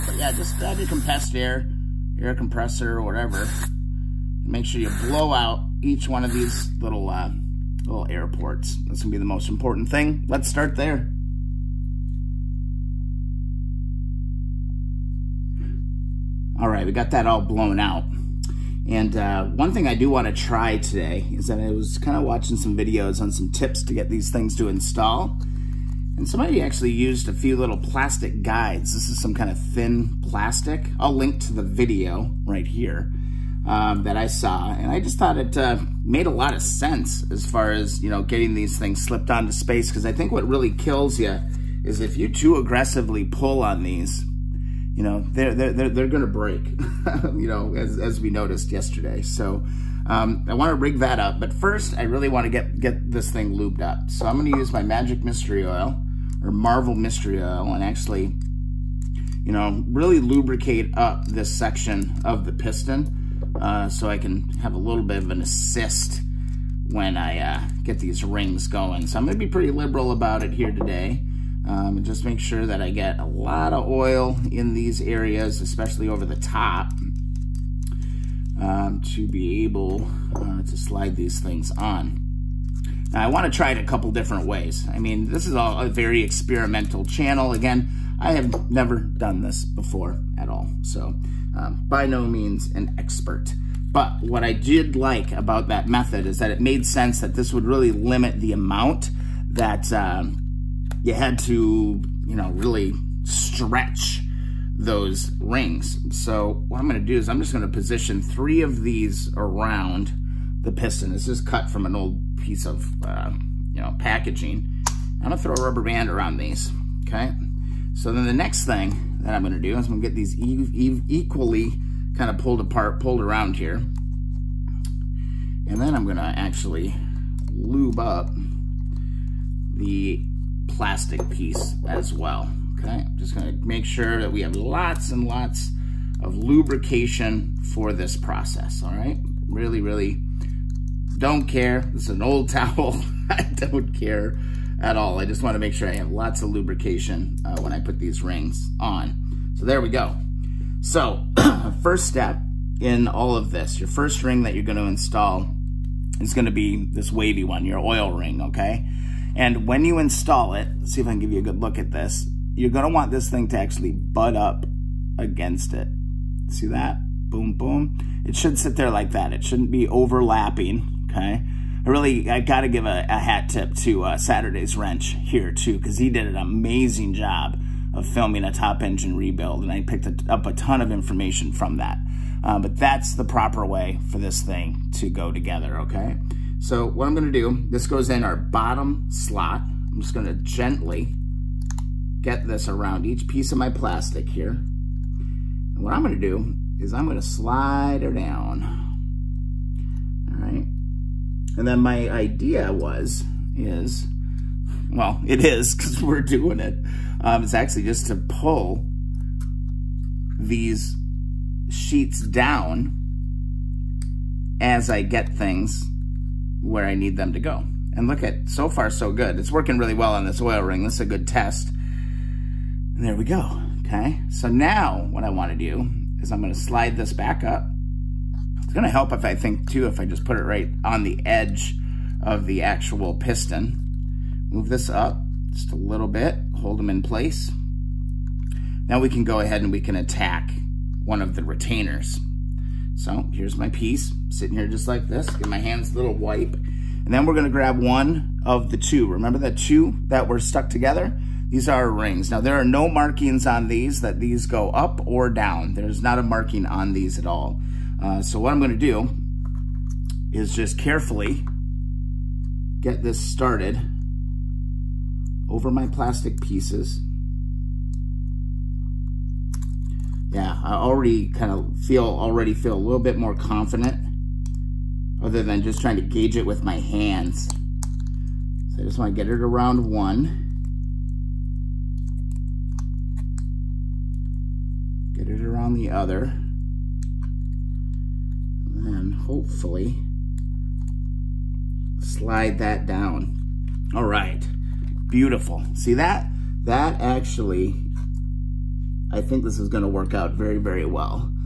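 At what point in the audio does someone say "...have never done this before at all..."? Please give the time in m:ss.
1:28.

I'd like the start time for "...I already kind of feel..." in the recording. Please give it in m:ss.
4:30.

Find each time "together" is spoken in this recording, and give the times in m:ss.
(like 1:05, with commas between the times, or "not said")
3:05, 4:10.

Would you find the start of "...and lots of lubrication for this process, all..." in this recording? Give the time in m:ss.
2:15.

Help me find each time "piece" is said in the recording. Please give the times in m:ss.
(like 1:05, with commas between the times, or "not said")
1:52, 2:11, 3:13, 4:03, 4:26.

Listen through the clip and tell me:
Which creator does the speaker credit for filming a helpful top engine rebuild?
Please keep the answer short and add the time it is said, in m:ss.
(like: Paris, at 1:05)
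Saturday's Wrench, at 2:54.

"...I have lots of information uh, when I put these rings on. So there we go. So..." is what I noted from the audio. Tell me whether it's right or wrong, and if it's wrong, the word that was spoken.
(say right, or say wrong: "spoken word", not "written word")
wrong: "lubrication", not "information".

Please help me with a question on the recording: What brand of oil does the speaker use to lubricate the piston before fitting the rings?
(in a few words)
Marvel Mystery Oil.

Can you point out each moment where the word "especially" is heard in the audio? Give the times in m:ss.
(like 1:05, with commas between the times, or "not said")
1:15.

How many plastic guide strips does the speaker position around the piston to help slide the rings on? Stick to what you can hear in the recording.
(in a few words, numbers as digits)
3.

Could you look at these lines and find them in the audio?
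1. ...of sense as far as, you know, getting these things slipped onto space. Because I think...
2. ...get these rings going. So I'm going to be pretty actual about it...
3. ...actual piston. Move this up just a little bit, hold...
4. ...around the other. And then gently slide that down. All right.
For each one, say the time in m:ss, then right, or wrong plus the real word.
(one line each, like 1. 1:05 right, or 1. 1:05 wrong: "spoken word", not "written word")
1. 0:36 right
2. 1:07 wrong: "liberal", not "actual"
3. 3:52 right
4. 4:45 wrong: "hopefully", not "gently".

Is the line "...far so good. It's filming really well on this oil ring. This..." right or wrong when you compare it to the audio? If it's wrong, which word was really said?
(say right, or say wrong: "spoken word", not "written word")
wrong: "working", not "filming".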